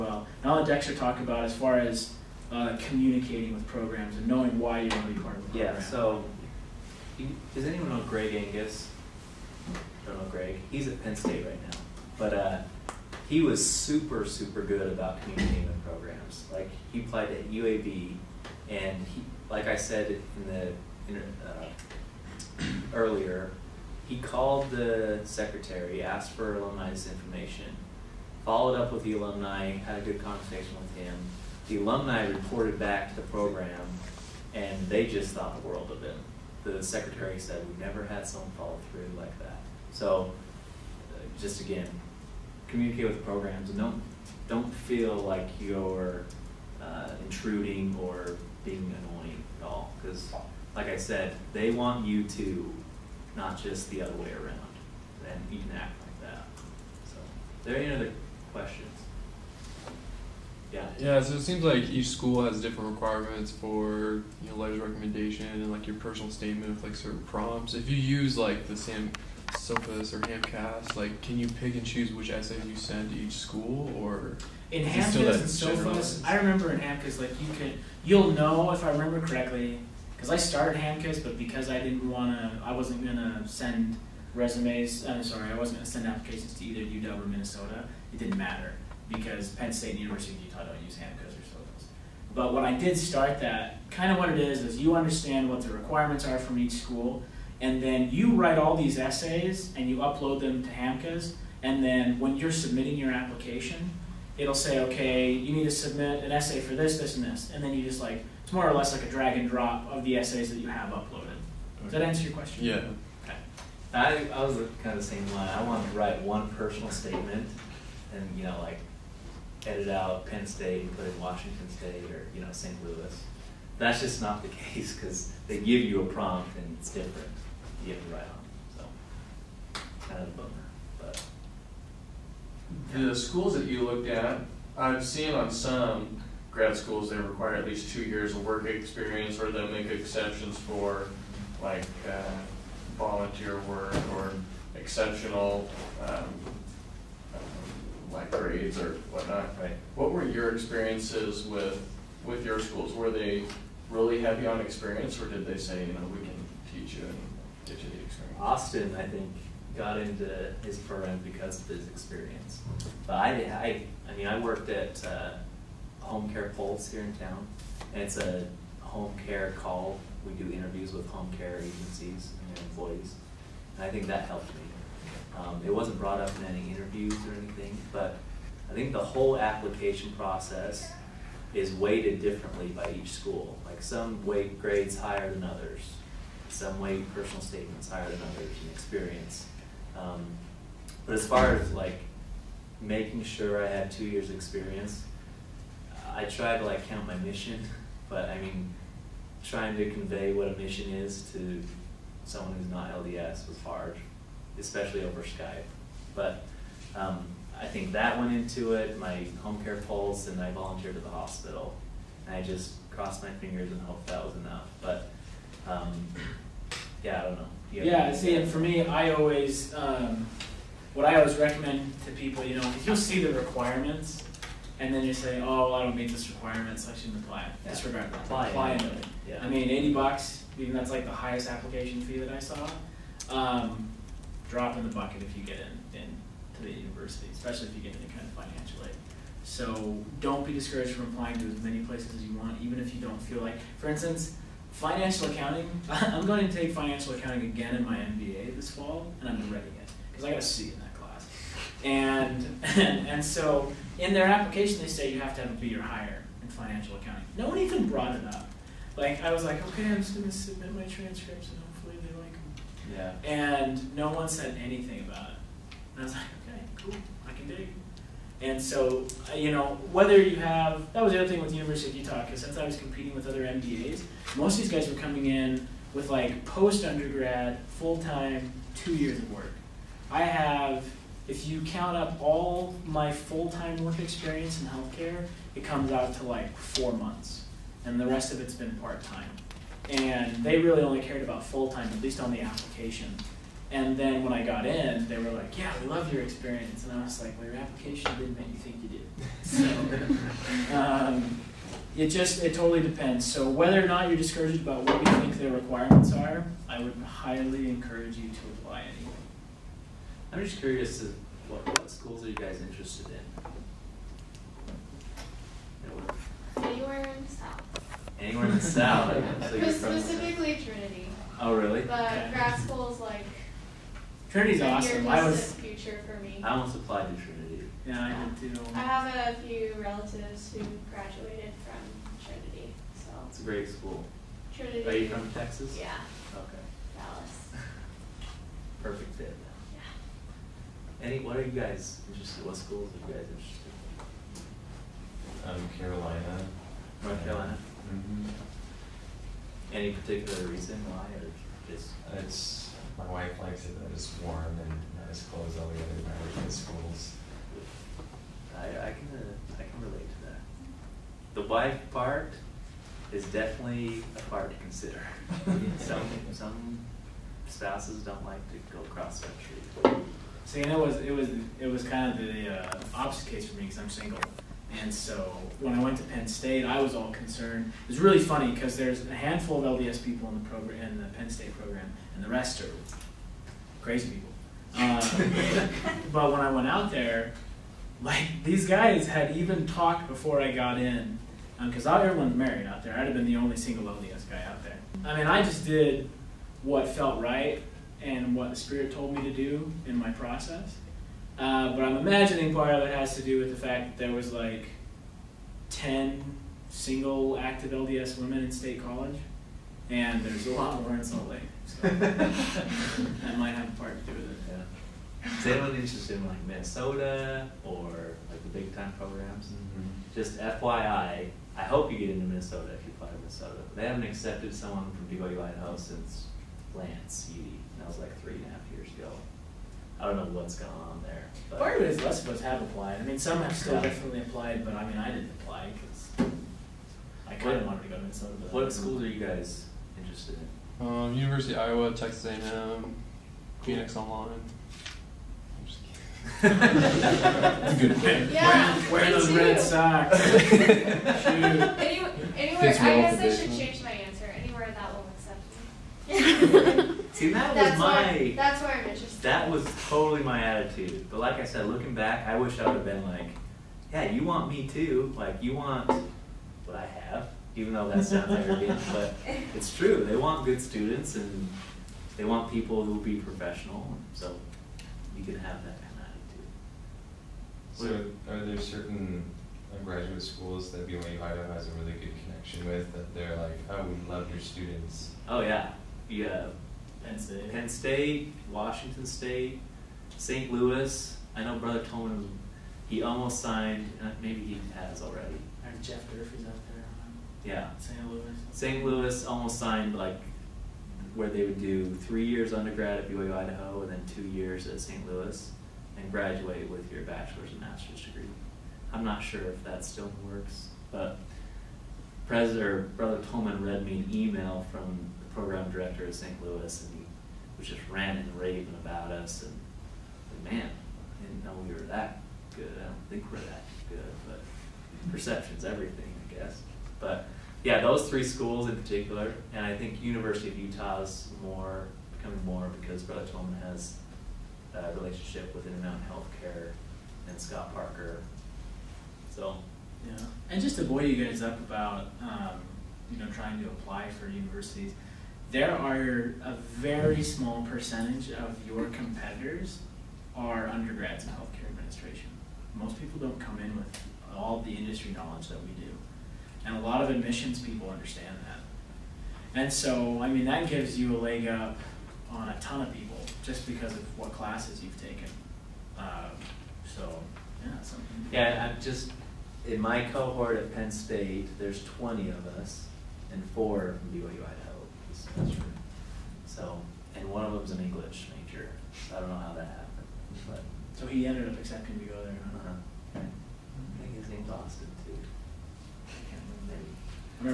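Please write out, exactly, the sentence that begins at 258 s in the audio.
Like, I was like, okay, I'm just going to submit my transcripts and hopefully they like them.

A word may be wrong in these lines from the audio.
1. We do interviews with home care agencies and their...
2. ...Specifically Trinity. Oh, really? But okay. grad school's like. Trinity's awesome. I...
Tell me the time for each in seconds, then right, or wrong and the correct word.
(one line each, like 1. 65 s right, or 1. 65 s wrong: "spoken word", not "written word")
1. 170 s right
2. 319 s right.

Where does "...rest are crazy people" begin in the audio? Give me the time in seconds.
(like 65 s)
382 s.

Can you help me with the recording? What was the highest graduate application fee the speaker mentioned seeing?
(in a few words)
$80.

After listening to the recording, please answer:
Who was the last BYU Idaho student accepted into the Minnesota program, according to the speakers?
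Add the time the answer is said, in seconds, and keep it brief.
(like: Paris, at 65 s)
Lance Eady, at 426 s.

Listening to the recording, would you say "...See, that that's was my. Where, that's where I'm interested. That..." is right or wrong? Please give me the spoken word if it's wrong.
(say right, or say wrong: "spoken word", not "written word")
right.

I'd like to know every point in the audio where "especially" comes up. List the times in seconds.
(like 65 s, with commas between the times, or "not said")
204 s, 237 s.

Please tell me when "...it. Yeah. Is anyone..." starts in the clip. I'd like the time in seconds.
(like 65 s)
414 s.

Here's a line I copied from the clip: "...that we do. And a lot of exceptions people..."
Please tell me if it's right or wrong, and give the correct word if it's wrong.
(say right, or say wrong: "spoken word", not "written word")
wrong: "admissions", not "exceptions".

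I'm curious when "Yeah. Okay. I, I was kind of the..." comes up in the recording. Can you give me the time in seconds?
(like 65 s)
112 s.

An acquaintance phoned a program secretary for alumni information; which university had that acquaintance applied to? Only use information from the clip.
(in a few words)
UAB.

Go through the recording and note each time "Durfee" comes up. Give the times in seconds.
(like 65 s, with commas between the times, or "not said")
496 s.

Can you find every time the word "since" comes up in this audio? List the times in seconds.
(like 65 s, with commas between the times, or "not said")
272 s, 425 s.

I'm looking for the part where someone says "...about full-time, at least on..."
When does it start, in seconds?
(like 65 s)
291 s.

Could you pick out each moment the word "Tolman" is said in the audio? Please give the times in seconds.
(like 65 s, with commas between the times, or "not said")
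491 s, 513 s, 533 s.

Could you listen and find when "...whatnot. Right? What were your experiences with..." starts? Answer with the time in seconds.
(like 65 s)
149 s.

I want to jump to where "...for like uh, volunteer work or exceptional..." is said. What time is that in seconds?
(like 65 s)
140 s.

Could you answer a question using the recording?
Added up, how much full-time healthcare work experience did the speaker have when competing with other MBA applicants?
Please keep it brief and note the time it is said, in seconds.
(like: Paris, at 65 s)
4 months, at 286 s.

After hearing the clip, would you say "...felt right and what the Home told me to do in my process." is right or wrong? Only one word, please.
wrong.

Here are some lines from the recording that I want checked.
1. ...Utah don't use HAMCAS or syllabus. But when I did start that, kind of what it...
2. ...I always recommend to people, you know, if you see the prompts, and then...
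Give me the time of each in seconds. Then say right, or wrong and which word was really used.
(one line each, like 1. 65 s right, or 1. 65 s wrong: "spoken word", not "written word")
1. 90 s right
2. 221 s wrong: "requirements", not "prompts".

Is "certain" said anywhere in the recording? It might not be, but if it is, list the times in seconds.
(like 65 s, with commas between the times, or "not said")
66 s, 478 s.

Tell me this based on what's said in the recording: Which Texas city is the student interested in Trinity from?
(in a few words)
Dallas.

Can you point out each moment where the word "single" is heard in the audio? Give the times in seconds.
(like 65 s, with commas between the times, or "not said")
373 s, 393 s, 406 s.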